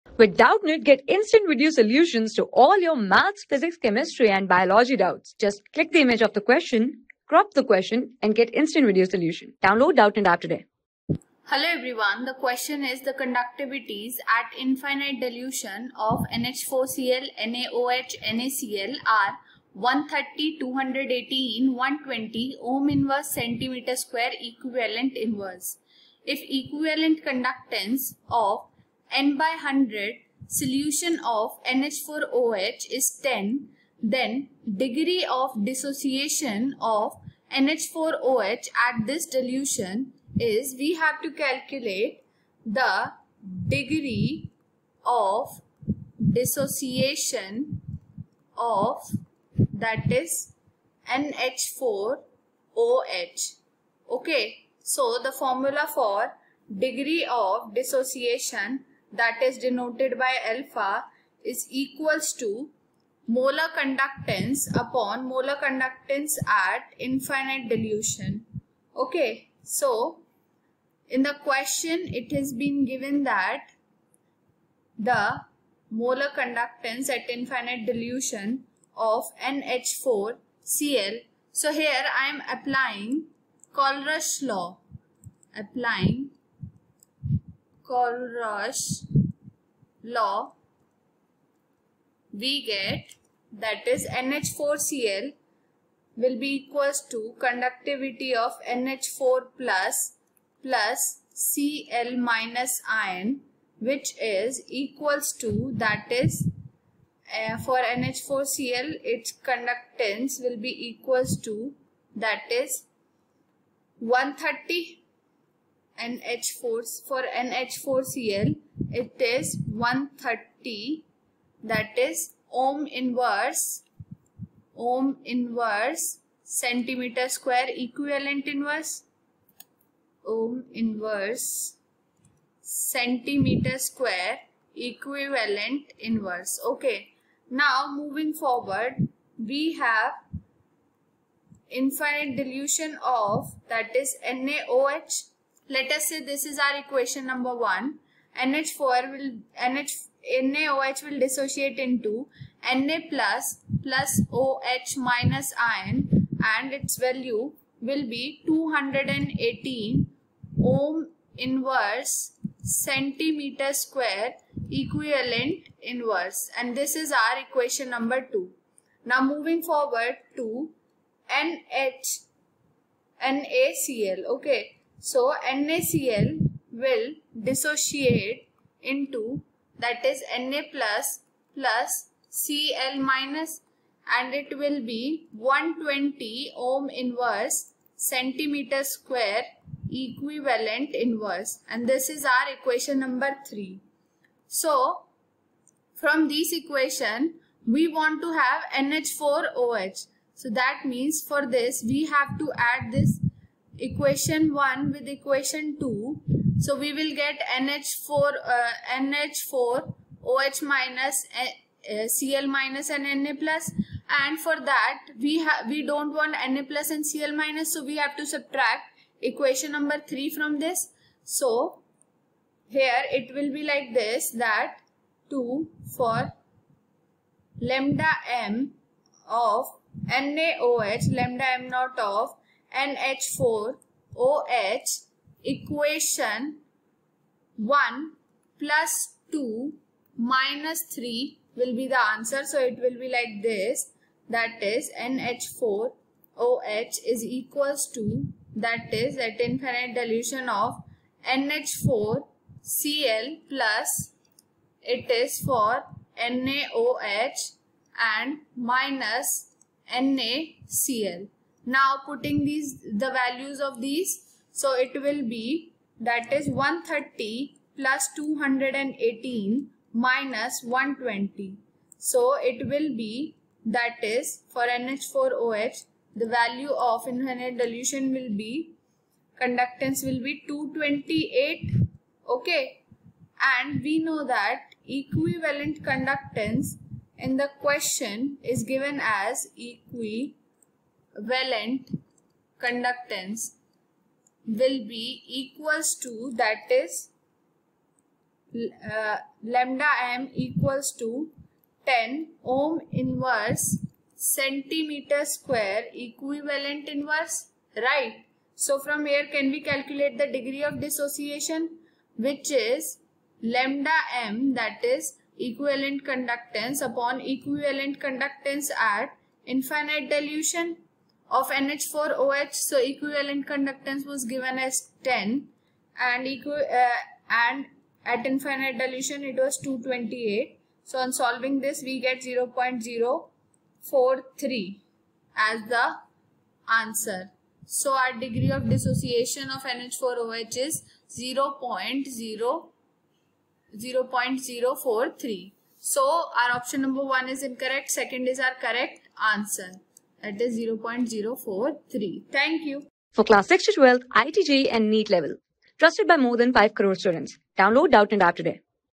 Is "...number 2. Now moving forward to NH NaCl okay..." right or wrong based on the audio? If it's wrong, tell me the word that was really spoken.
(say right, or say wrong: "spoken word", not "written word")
right.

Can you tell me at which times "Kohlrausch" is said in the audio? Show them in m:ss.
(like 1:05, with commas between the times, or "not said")
1:23, 1:27.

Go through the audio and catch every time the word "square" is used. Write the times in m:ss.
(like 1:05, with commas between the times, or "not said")
0:23, 2:07, 2:13, 2:43, 3:08, 5:05.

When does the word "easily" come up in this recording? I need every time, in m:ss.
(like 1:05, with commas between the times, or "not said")
not said.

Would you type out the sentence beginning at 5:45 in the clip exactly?
So our option number 1 is incorrect, second is our correct answer that is 0.043.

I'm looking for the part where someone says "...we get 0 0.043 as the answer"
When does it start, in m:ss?
5:31.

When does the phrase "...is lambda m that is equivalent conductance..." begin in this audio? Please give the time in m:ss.
5:12.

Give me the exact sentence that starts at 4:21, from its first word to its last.
Now putting these the values of these so it will be that is 130 plus 218 minus 120.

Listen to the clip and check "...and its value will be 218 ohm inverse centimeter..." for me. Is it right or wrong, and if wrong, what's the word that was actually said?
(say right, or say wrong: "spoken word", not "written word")
right.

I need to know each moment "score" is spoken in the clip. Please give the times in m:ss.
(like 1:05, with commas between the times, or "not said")
not said.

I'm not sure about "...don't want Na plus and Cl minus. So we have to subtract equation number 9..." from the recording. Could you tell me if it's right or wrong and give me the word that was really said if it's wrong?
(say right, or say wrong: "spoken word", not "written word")
wrong: "3", not "9".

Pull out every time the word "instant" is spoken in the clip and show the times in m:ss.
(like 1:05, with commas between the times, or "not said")
0:01, 0:08.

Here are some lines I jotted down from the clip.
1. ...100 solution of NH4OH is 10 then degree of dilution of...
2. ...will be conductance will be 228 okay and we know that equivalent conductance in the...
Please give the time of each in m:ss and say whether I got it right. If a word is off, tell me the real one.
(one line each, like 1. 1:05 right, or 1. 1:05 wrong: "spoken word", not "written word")
1. 0:29 wrong: "dissociation", not "dilution"
2. 4:38 right.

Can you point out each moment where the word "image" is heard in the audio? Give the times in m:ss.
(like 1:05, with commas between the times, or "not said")
0:06.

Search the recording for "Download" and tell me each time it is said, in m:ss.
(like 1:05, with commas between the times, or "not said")
0:09, 5:57.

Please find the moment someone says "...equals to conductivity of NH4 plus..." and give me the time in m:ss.
1:36.